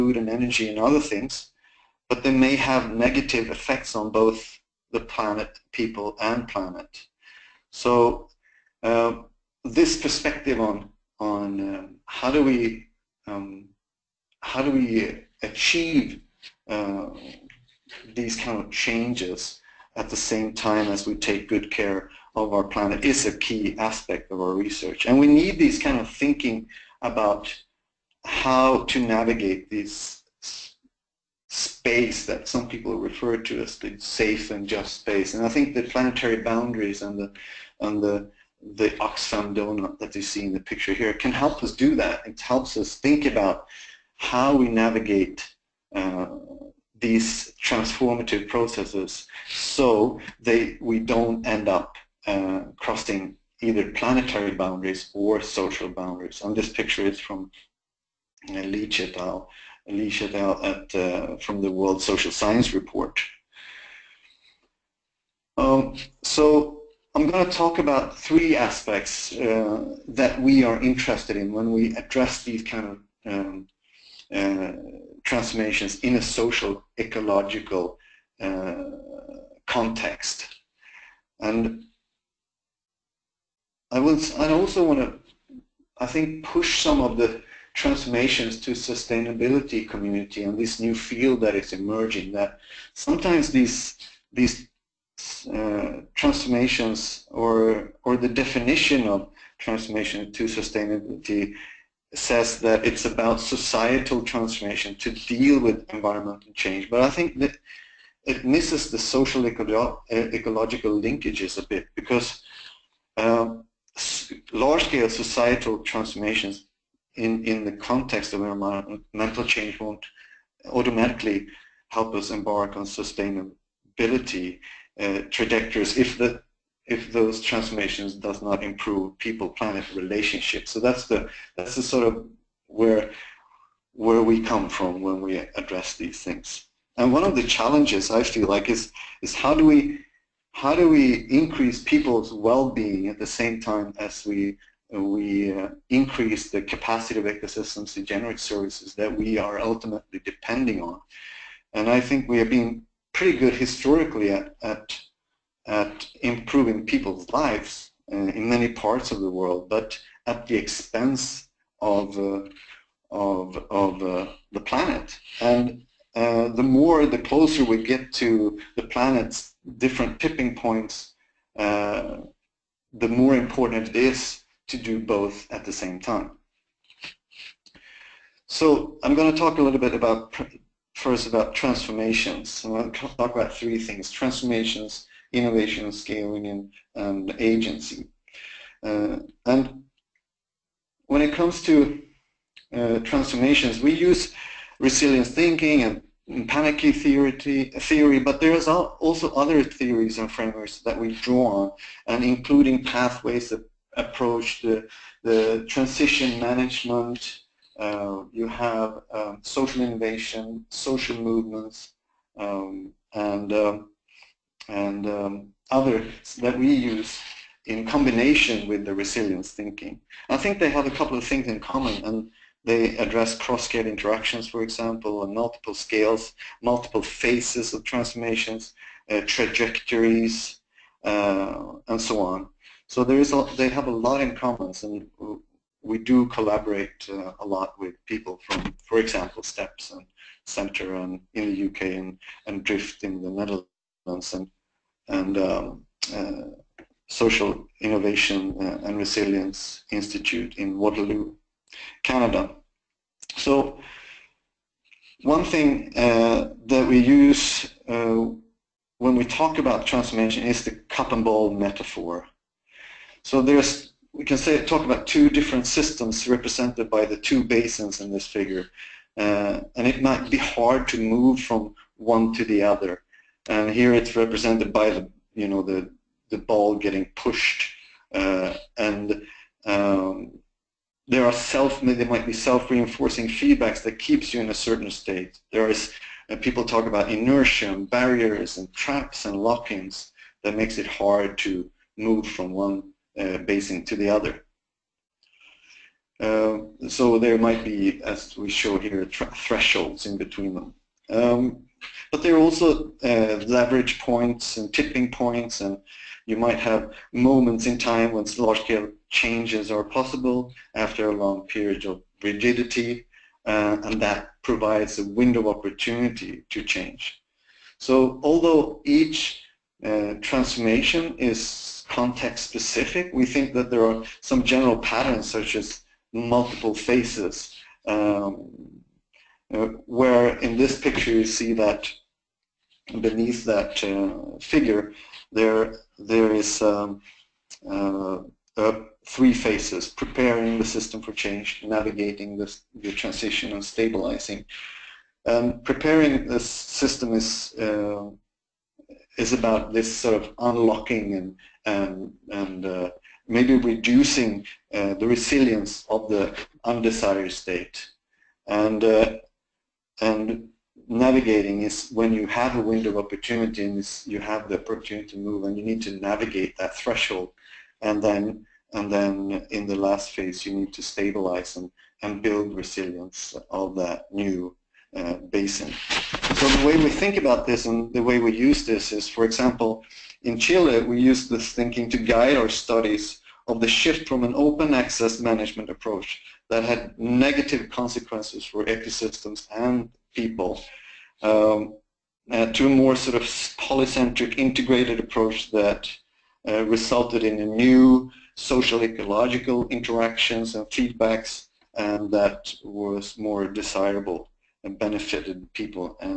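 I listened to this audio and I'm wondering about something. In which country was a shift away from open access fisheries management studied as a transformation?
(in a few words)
Chile.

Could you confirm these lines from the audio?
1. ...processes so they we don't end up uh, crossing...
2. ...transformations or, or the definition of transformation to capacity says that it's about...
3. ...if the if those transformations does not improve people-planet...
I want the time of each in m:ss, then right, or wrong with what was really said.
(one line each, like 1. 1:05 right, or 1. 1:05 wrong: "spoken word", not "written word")
1. 0:48 right
2. 1:36 wrong: "sustainability", not "capacity"
3. 2:05 right.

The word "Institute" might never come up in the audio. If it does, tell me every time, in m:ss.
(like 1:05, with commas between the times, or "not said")
4:09.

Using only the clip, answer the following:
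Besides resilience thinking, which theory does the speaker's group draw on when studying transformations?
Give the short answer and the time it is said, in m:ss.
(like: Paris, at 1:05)
Panarchy theory, at 3:16.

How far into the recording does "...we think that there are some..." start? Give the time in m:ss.
5:23.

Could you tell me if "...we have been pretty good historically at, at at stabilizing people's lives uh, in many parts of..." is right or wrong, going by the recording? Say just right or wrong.
wrong.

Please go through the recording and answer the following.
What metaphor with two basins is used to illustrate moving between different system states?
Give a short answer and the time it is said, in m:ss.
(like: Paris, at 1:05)
Cup and ball, at 4:20.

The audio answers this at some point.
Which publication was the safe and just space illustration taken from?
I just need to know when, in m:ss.
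1:01.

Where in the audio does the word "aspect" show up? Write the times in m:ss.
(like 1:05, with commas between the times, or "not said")
0:23, 1:08.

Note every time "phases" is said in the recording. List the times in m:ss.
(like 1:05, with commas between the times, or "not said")
3:47, 5:26, 5:39, 6:10.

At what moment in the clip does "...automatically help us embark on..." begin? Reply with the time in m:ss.
2:00.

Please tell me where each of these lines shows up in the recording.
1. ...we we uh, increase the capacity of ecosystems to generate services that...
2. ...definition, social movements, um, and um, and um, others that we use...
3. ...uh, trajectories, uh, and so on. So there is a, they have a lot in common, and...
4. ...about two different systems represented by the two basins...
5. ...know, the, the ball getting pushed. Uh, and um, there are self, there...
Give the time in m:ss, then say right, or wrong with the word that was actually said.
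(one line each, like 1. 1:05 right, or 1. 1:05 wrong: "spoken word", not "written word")
1. 2:24 right
2. 3:29 wrong: "innovation", not "definition"
3. 3:49 right
4. 4:24 right
5. 4:35 right.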